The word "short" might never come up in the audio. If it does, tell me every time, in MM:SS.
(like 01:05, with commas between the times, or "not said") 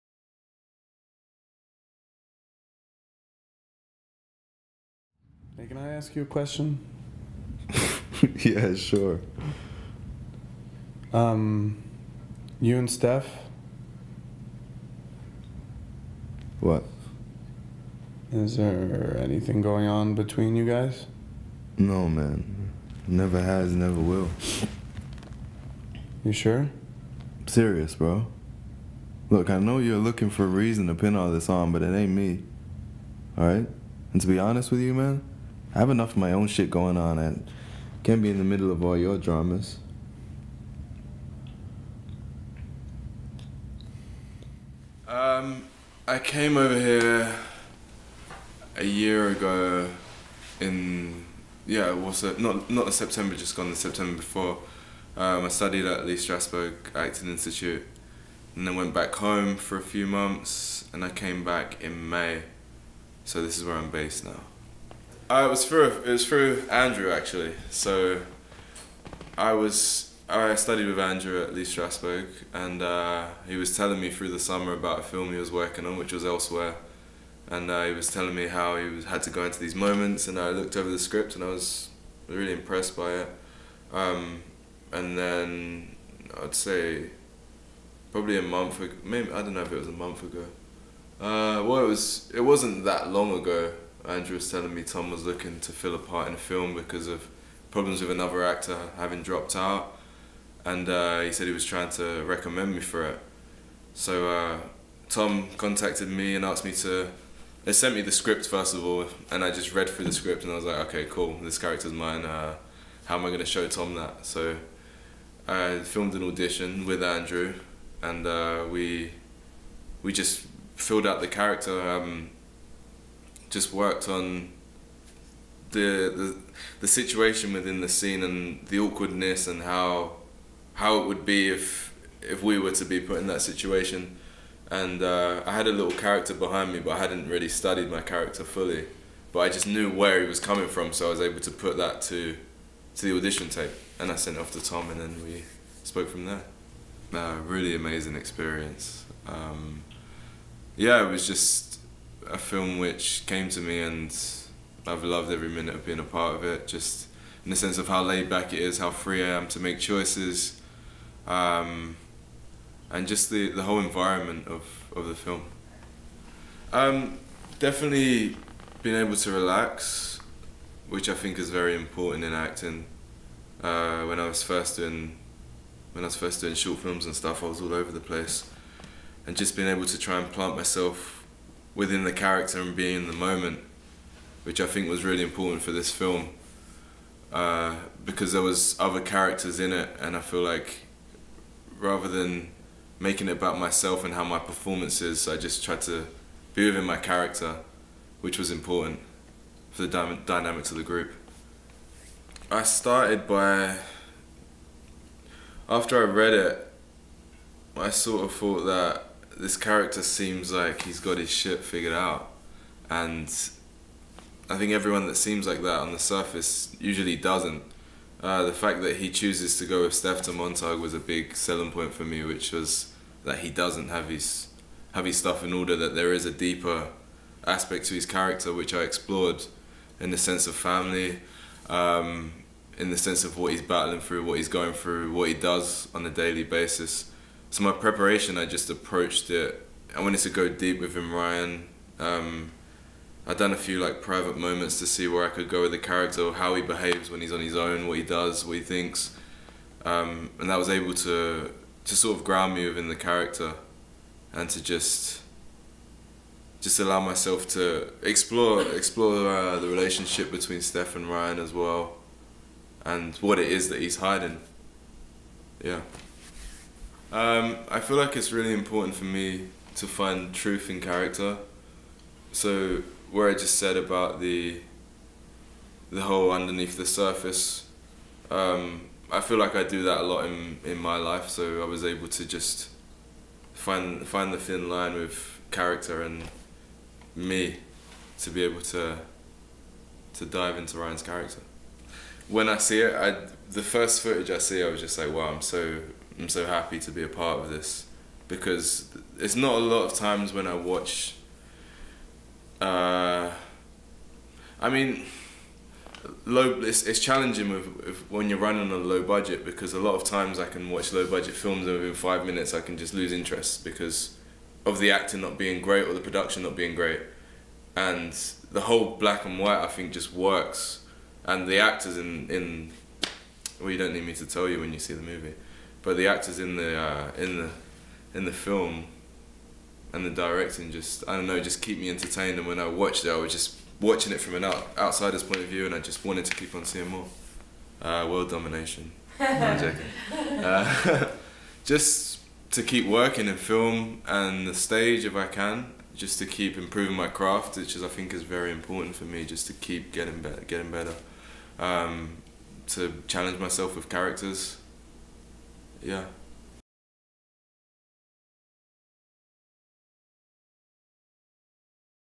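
02:56.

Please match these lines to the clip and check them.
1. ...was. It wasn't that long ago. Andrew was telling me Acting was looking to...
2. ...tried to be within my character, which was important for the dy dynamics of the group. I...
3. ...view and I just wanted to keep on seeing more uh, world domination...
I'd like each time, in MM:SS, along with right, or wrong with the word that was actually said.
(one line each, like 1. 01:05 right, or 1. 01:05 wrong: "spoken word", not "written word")
1. 01:31 wrong: "Tom", not "Acting"
2. 03:15 right
3. 05:35 right.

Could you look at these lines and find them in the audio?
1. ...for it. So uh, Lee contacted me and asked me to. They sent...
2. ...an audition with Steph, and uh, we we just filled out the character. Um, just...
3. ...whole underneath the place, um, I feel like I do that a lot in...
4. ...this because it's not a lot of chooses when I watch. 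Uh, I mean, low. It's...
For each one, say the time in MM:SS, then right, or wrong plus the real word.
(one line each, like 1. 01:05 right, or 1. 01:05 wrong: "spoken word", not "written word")
1. 01:42 wrong: "Tom", not "Lee"
2. 01:56 wrong: "Andrew", not "Steph"
3. 04:36 wrong: "surface", not "place"
4. 04:57 wrong: "times", not "chooses".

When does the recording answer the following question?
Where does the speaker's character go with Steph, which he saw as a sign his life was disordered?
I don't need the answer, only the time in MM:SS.
03:40.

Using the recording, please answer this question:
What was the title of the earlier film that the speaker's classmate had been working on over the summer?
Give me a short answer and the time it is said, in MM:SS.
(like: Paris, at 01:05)
Elsewhere, at 01:16.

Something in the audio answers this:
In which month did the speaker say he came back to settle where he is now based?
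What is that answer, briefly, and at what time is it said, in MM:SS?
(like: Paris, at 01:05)
May, at 01:02.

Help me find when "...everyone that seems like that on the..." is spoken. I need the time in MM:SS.
03:34.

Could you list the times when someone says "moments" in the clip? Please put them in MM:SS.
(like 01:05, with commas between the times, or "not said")
01:19, 03:03, 04:04.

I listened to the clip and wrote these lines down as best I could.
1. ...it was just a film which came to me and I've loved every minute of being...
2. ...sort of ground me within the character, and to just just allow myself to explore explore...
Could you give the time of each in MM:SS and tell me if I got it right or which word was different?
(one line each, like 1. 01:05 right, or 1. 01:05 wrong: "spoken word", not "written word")
1. 02:31 right
2. 04:11 right.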